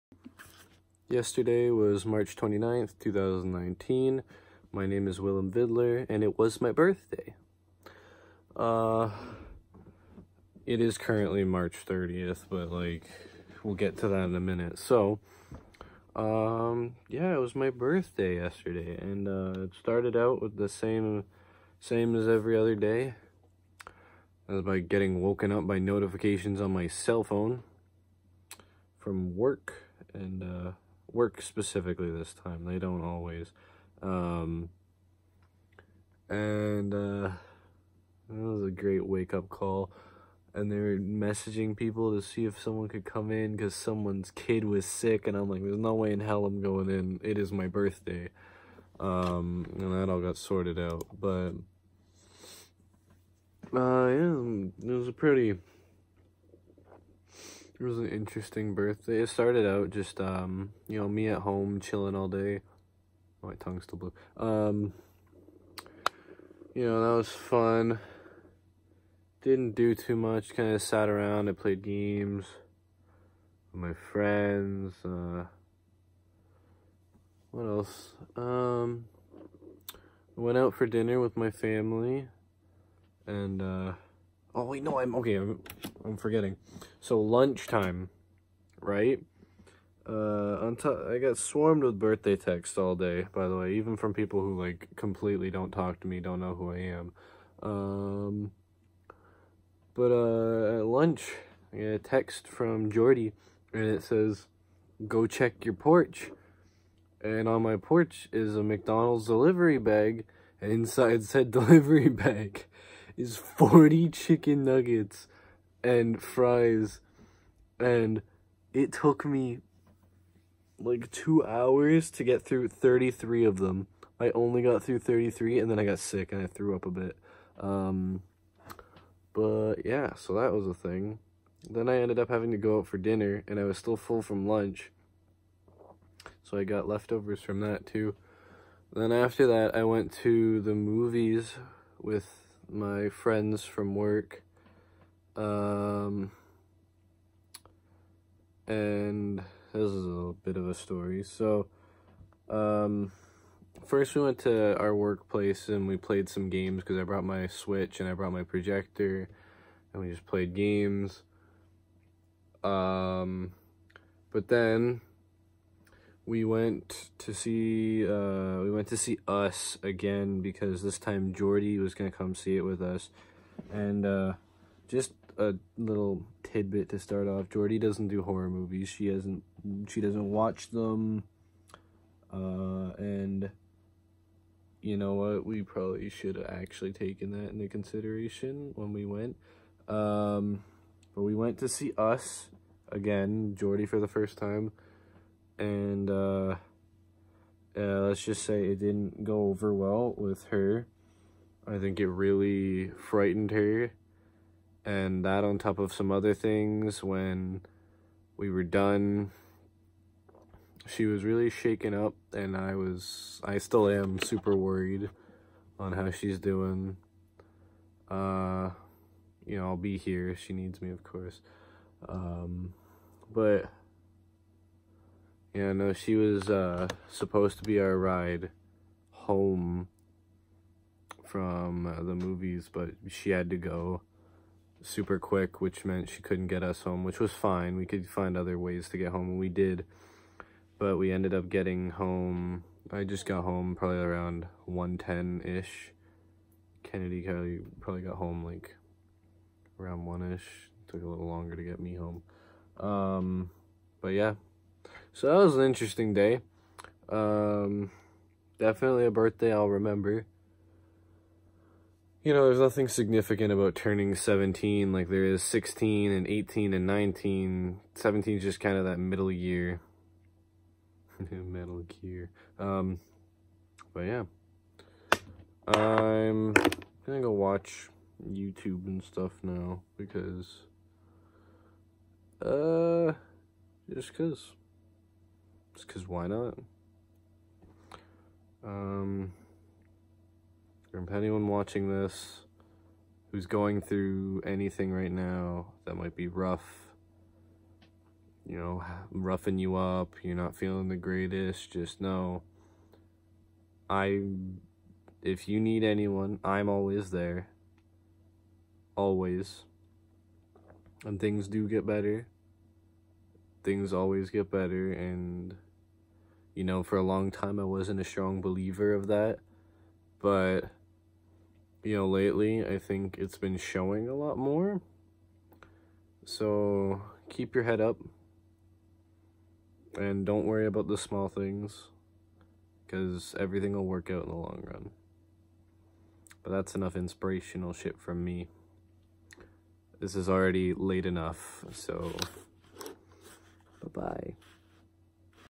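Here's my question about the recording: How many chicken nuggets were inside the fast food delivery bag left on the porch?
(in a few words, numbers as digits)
40.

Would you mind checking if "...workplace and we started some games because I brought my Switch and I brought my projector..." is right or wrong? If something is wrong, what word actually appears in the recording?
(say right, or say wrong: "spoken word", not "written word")
wrong: "played", not "started".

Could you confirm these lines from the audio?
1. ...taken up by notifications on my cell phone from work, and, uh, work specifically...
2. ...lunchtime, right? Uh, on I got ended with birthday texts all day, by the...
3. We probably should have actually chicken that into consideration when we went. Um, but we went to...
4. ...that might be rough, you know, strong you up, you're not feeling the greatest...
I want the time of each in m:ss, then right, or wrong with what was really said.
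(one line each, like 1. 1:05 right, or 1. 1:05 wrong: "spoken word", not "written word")
1. 0:25 wrong: "woken", not "taken"
2. 1:27 wrong: "swarmed", not "ended"
3. 3:05 wrong: "taken", not "chicken"
4. 4:55 wrong: "roughing", not "strong".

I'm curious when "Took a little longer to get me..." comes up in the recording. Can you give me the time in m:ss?
4:10.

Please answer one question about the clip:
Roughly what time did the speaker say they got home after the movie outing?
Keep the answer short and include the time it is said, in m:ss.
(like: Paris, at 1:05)
1:10, at 4:04.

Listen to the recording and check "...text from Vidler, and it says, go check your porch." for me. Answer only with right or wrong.
wrong.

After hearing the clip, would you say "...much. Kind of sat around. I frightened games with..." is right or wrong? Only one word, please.
wrong.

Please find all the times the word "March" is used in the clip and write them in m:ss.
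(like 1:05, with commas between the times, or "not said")
0:02, 0:11.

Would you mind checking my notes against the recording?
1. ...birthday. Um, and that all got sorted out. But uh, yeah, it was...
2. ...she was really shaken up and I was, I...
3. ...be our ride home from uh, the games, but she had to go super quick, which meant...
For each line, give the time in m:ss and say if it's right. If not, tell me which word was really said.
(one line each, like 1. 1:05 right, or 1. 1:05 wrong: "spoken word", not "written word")
1. 0:47 right
2. 3:30 right
3. 3:47 wrong: "movies", not "games".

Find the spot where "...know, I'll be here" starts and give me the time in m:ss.
3:39.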